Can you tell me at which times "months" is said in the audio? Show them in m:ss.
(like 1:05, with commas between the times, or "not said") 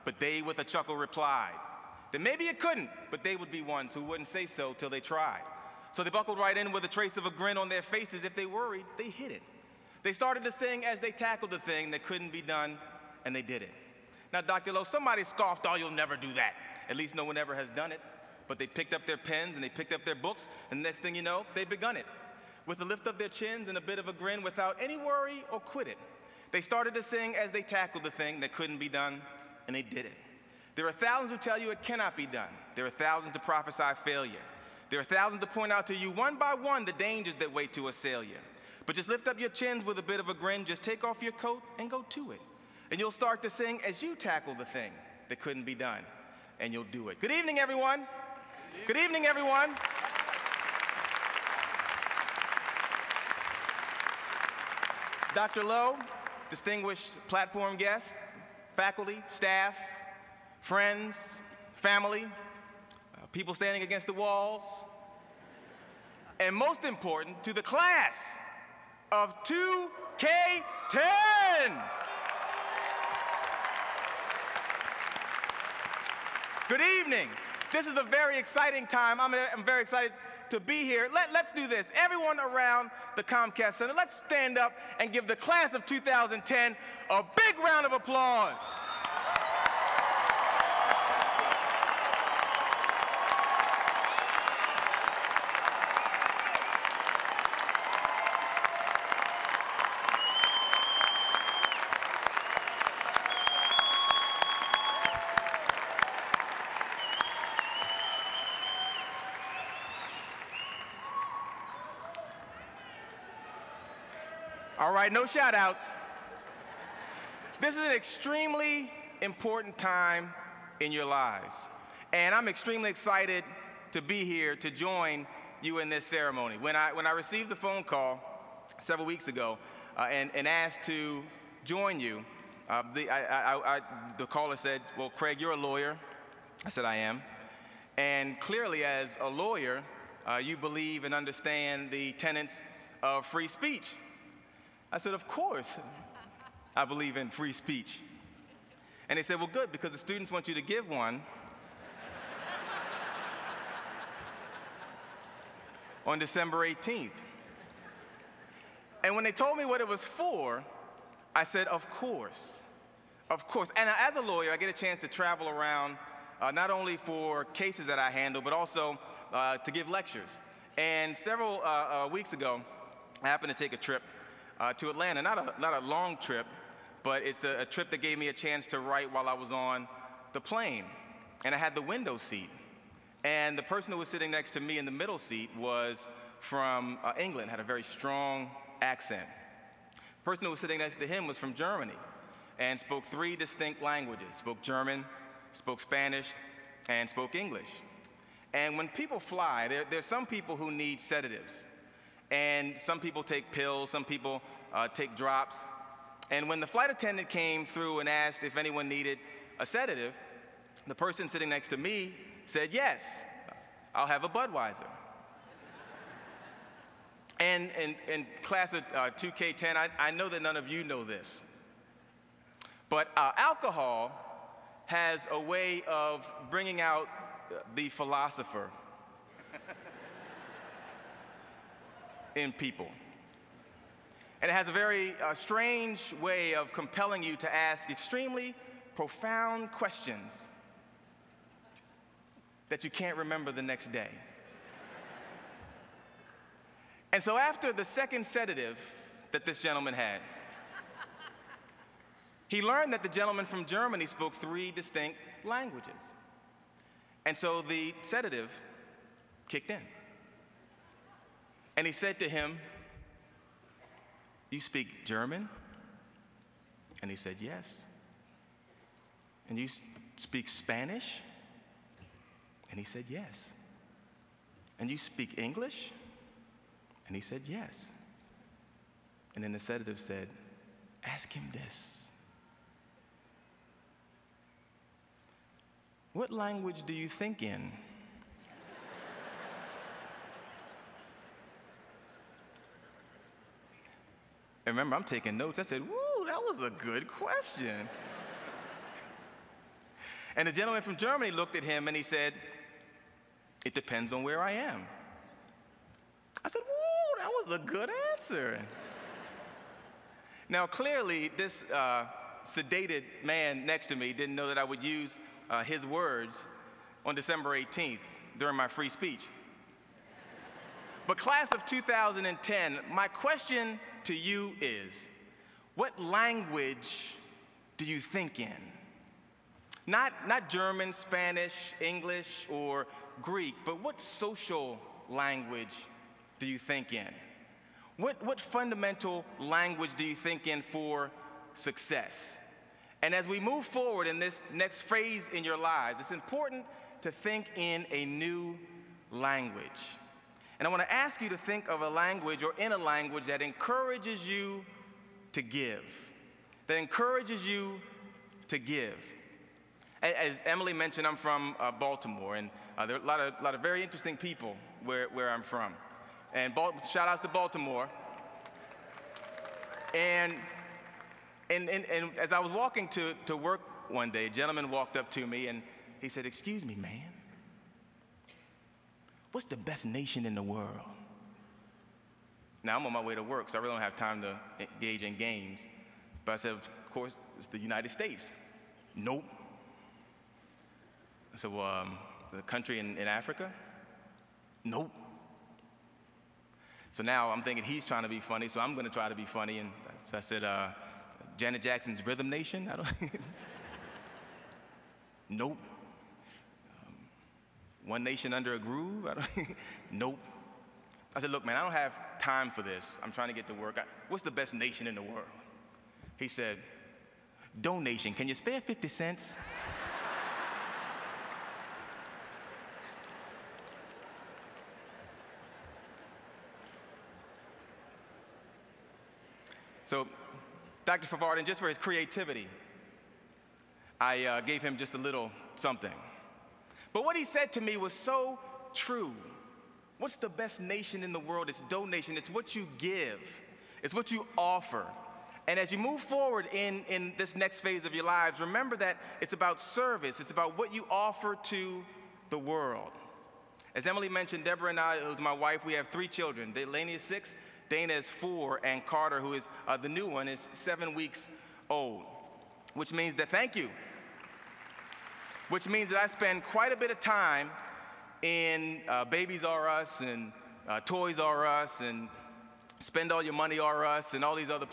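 not said.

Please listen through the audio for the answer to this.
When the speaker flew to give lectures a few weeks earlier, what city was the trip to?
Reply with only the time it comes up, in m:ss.
2:54.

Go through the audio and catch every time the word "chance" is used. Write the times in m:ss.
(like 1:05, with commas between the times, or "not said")
2:44, 2:58.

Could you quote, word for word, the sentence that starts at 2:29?
And they said, Well, good, because the students want you to give one.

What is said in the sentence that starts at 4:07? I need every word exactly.
and so, after the second sedative that this gentleman had, he learned that the gentleman from Germany spoke three distinct languages.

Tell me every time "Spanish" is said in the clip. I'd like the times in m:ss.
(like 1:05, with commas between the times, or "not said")
3:15, 4:30, 5:30.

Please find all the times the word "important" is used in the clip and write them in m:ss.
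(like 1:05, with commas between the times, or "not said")
1:06, 1:59, 5:46.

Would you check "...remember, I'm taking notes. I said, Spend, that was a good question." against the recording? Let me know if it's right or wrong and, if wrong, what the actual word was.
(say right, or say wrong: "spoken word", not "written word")
wrong: "Woo", not "Spend".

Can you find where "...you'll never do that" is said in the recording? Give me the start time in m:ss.
0:15.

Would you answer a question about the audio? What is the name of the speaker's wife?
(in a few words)
Deborah.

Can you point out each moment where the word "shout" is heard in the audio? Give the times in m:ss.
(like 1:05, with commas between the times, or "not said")
1:55, 6:06.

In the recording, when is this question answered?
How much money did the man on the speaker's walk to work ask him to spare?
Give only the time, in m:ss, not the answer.
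6:58.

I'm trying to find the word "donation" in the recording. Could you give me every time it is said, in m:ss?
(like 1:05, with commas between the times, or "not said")
6:57, 7:21.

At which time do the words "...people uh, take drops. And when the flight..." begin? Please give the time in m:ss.
3:24.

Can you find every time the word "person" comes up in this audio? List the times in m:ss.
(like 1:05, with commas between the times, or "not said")
3:03, 3:10, 3:30.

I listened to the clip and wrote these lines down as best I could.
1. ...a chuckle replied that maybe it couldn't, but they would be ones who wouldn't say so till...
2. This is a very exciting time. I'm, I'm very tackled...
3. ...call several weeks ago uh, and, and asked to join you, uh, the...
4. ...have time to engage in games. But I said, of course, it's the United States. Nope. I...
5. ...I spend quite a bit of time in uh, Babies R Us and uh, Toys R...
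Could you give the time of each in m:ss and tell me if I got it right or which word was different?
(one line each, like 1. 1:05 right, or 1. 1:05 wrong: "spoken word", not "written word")
1. 0:00 right
2. 1:17 wrong: "excited", not "tackled"
3. 2:07 right
4. 6:23 right
5. 7:45 right.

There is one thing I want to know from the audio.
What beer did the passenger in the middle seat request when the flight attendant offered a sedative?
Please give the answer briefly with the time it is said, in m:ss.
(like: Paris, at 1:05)
Budweiser, at 3:34.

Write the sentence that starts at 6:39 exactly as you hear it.
And so I said, uh, Janet Jackson's Rhythm Nation?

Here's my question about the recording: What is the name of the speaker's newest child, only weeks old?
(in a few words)
Carter.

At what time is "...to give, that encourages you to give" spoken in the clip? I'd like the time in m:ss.
5:55.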